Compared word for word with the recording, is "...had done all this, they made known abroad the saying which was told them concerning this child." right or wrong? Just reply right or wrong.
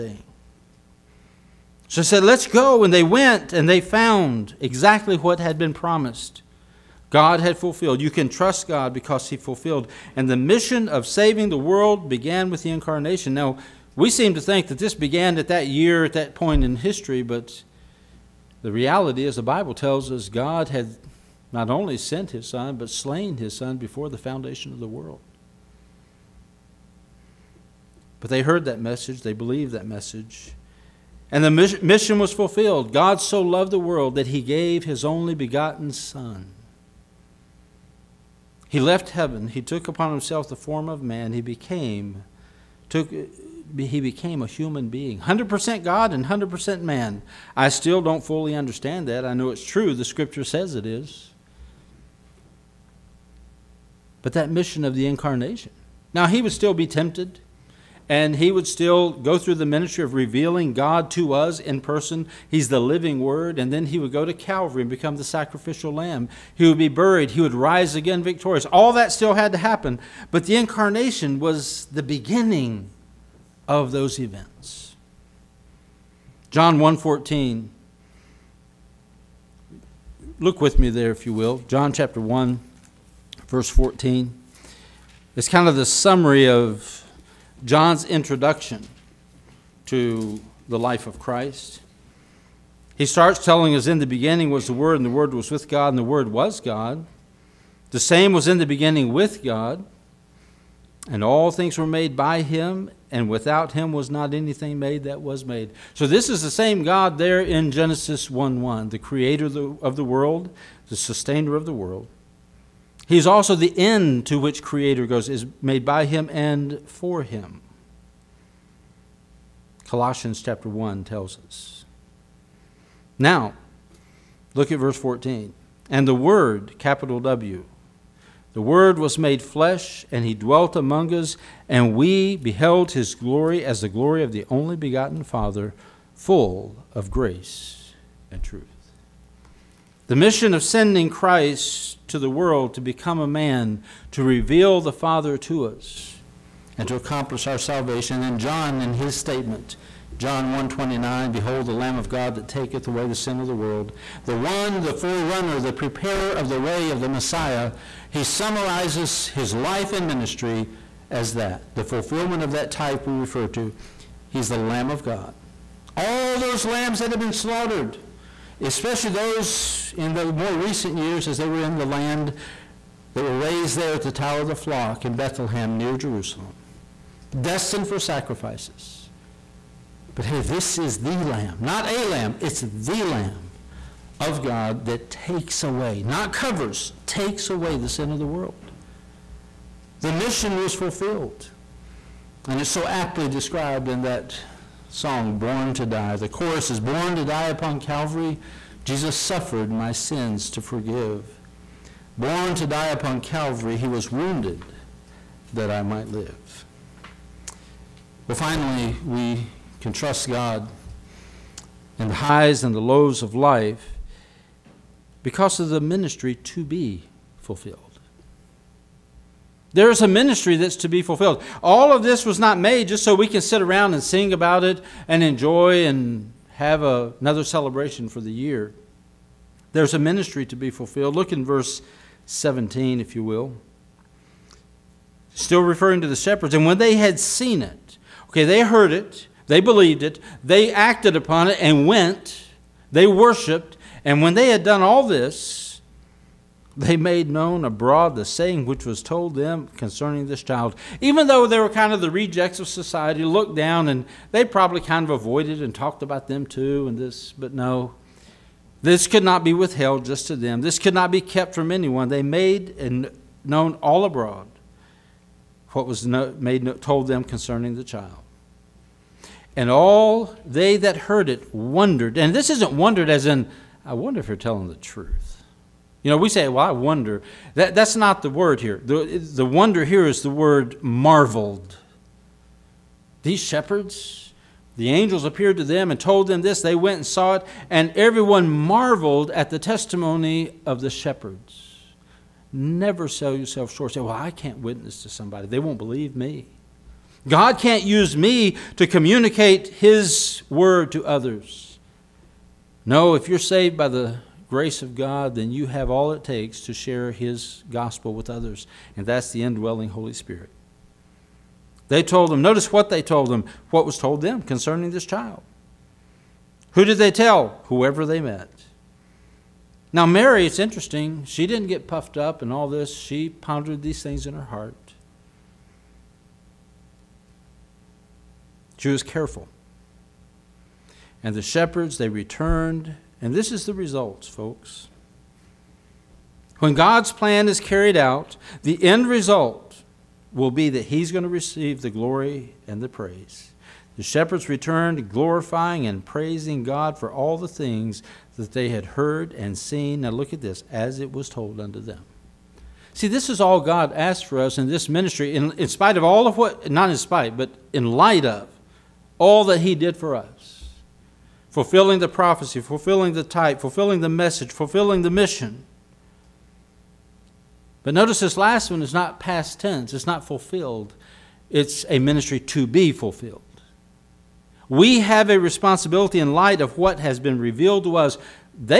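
right.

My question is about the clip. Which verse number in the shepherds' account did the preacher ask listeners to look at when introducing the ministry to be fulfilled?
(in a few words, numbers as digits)
17.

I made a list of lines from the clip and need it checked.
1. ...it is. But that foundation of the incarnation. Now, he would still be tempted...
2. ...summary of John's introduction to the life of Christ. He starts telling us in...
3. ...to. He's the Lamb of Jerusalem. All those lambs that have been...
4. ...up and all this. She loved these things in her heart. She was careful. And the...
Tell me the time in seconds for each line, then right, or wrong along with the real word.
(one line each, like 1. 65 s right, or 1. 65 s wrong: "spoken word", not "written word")
1. 50 s wrong: "mission", not "foundation"
2. 85 s right
3. 163 s wrong: "God", not "Jerusalem"
4. 322 s wrong: "pondered", not "loved".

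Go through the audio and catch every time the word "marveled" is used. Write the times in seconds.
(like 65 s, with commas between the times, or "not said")
280 s, 288 s.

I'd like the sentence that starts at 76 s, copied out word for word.
John 1:14 Look with me there if you will.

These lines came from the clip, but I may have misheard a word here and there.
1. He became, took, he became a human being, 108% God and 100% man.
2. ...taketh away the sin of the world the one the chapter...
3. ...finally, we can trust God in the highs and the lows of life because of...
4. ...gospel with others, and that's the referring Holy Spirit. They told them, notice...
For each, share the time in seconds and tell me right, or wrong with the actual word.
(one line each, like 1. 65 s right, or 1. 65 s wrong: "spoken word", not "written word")
1. 41 s wrong: "100", not "108"
2. 152 s wrong: "forerunner", not "chapter"
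3. 208 s right
4. 307 s wrong: "indwelling", not "referring".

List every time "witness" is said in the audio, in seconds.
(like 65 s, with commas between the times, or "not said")
294 s.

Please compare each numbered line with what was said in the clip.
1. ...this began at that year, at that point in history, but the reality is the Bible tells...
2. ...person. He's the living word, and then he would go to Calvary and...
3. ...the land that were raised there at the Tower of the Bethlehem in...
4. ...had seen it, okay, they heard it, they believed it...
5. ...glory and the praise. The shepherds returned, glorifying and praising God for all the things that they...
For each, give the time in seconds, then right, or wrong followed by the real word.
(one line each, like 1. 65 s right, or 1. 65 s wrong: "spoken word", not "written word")
1. 14 s right
2. 61 s right
3. 171 s wrong: "Flock", not "Bethlehem"
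4. 236 s right
5. 341 s right.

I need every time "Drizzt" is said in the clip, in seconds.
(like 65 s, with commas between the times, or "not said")
not said.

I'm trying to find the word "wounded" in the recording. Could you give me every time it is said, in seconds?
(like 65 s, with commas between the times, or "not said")
204 s.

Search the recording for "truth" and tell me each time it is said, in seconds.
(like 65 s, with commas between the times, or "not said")
138 s, 274 s.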